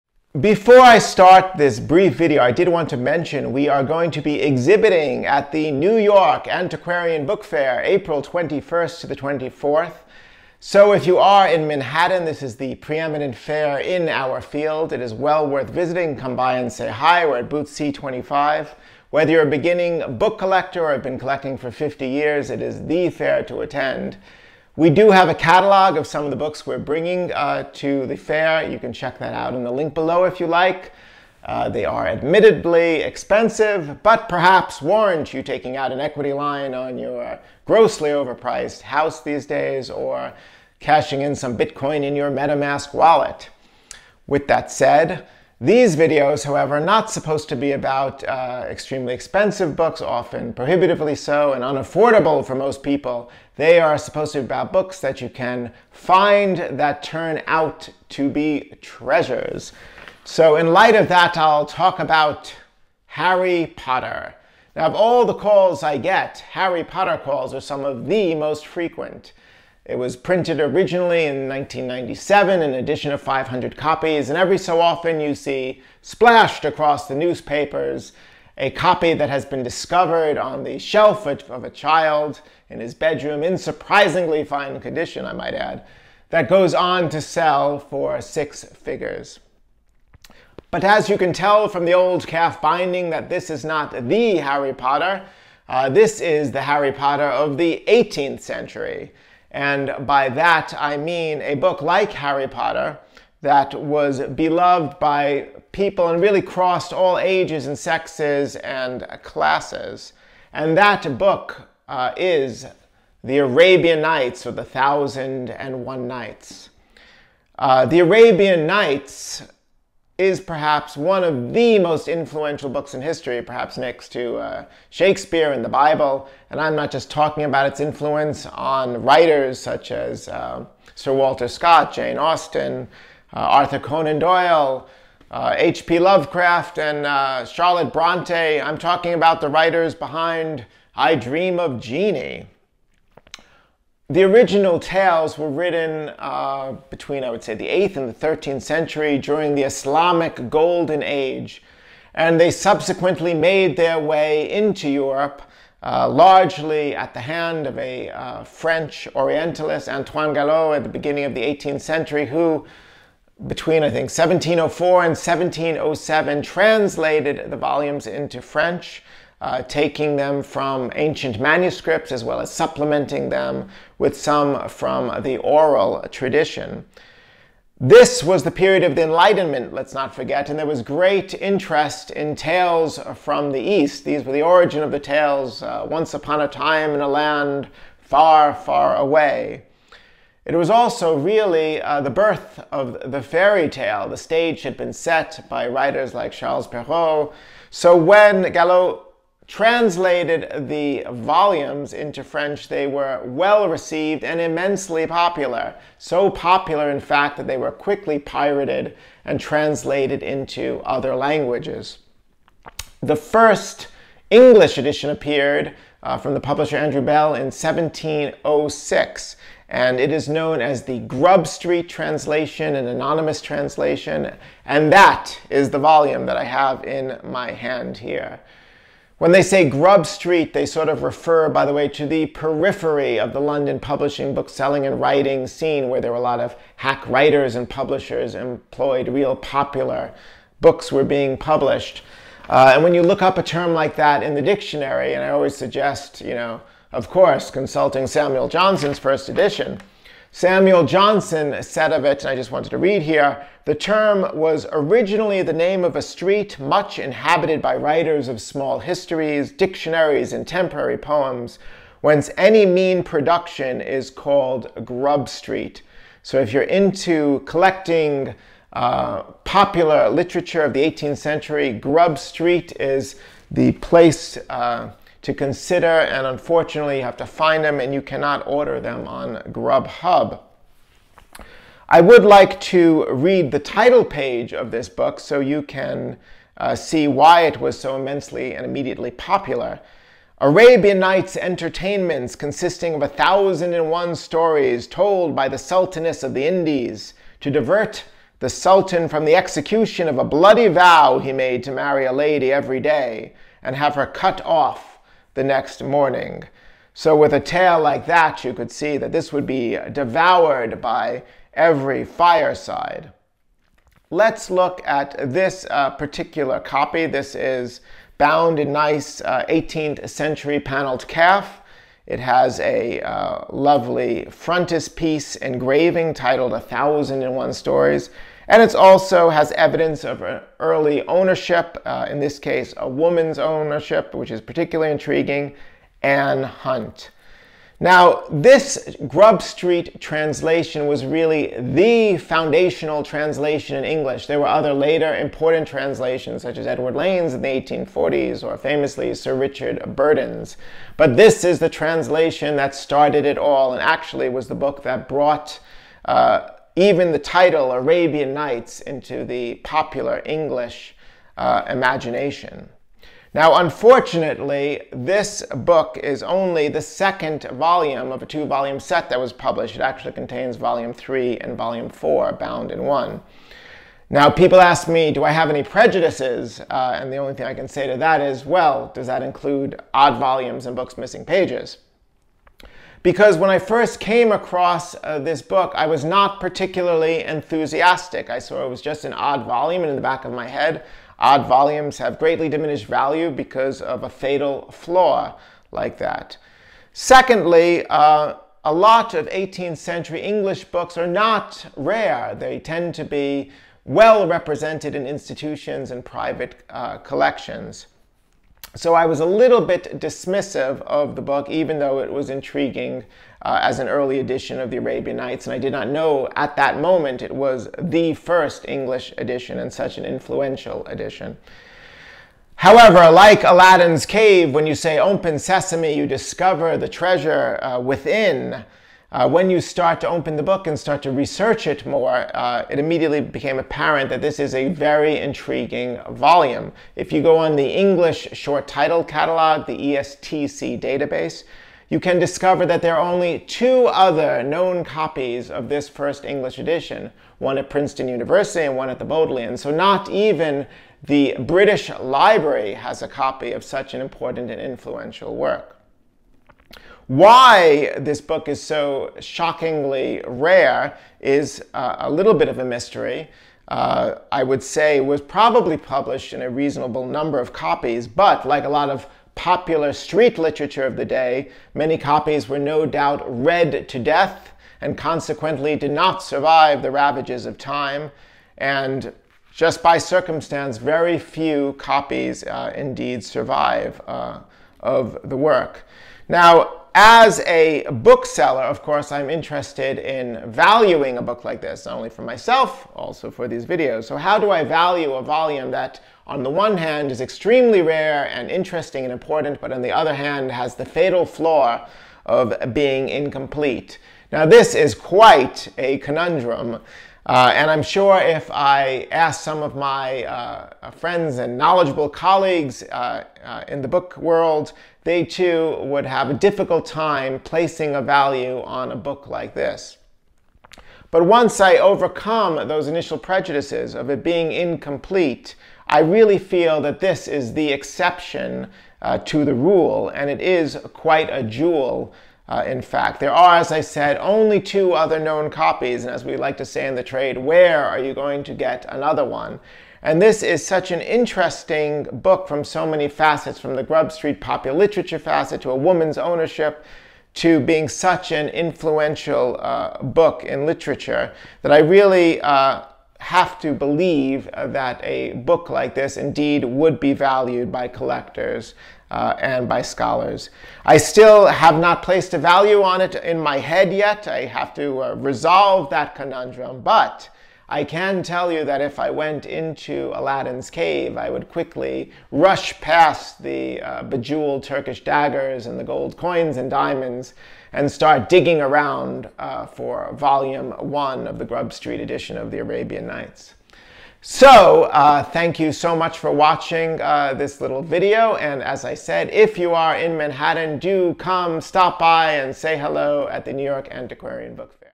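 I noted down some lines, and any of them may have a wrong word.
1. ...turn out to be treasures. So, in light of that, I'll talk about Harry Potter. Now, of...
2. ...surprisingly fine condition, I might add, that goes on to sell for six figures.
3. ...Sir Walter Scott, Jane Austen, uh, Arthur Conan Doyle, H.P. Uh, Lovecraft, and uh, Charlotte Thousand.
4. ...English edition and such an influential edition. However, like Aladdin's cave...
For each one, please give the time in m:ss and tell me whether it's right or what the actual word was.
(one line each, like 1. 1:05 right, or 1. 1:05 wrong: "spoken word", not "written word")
1. 0:57 right
2. 1:23 right
3. 2:10 wrong: "Bronte", not "Thousand"
4. 6:58 right.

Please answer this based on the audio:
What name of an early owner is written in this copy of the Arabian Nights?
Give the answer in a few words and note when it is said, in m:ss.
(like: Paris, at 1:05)
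Anne Hunt, at 5:36.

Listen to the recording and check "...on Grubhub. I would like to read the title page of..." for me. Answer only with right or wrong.
right.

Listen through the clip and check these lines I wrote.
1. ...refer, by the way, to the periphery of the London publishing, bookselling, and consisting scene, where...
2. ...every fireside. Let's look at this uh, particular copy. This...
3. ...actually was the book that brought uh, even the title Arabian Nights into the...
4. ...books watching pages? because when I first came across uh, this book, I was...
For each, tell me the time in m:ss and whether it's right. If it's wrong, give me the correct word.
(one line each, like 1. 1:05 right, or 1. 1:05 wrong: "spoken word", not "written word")
1. 3:51 wrong: "writing", not "consisting"
2. 5:11 right
3. 5:53 right
4. 6:20 wrong: "missing", not "watching".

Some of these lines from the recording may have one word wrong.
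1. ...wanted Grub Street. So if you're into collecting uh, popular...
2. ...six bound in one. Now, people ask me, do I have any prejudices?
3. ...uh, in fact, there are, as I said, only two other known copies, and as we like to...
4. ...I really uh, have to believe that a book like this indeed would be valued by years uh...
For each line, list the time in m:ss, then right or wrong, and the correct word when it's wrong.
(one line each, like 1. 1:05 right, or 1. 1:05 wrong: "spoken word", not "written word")
1. 4:24 wrong: "called", not "wanted"
2. 6:11 wrong: "four", not "six"
3. 8:52 right
4. 9:11 wrong: "collectors", not "years".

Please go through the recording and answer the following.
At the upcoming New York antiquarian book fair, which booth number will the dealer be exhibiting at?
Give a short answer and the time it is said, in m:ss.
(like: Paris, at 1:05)
C25, at 0:17.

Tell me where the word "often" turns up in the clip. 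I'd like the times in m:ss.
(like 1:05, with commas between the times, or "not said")
0:50, 1:14.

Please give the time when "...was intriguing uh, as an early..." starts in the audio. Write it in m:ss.
6:52.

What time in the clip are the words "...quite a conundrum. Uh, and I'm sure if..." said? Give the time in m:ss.
8:24.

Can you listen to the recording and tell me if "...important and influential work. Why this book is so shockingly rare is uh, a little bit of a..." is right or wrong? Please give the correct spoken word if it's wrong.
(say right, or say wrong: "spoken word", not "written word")
right.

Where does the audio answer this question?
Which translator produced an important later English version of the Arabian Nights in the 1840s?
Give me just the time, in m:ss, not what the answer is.
5:46.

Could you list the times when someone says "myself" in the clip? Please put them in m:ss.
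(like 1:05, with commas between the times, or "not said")
8:12.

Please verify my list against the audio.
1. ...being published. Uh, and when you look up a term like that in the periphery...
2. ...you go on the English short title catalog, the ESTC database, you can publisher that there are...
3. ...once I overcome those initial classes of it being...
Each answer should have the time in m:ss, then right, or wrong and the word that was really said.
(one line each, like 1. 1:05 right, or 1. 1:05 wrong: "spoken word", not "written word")
1. 4:01 wrong: "dictionary", not "periphery"
2. 7:17 wrong: "discover", not "publisher"
3. 8:41 wrong: "prejudices", not "classes".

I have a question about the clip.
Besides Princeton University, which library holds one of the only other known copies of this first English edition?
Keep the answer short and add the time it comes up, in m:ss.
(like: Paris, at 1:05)
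The Bodleian, at 7:28.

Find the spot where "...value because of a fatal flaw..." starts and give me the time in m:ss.
6:32.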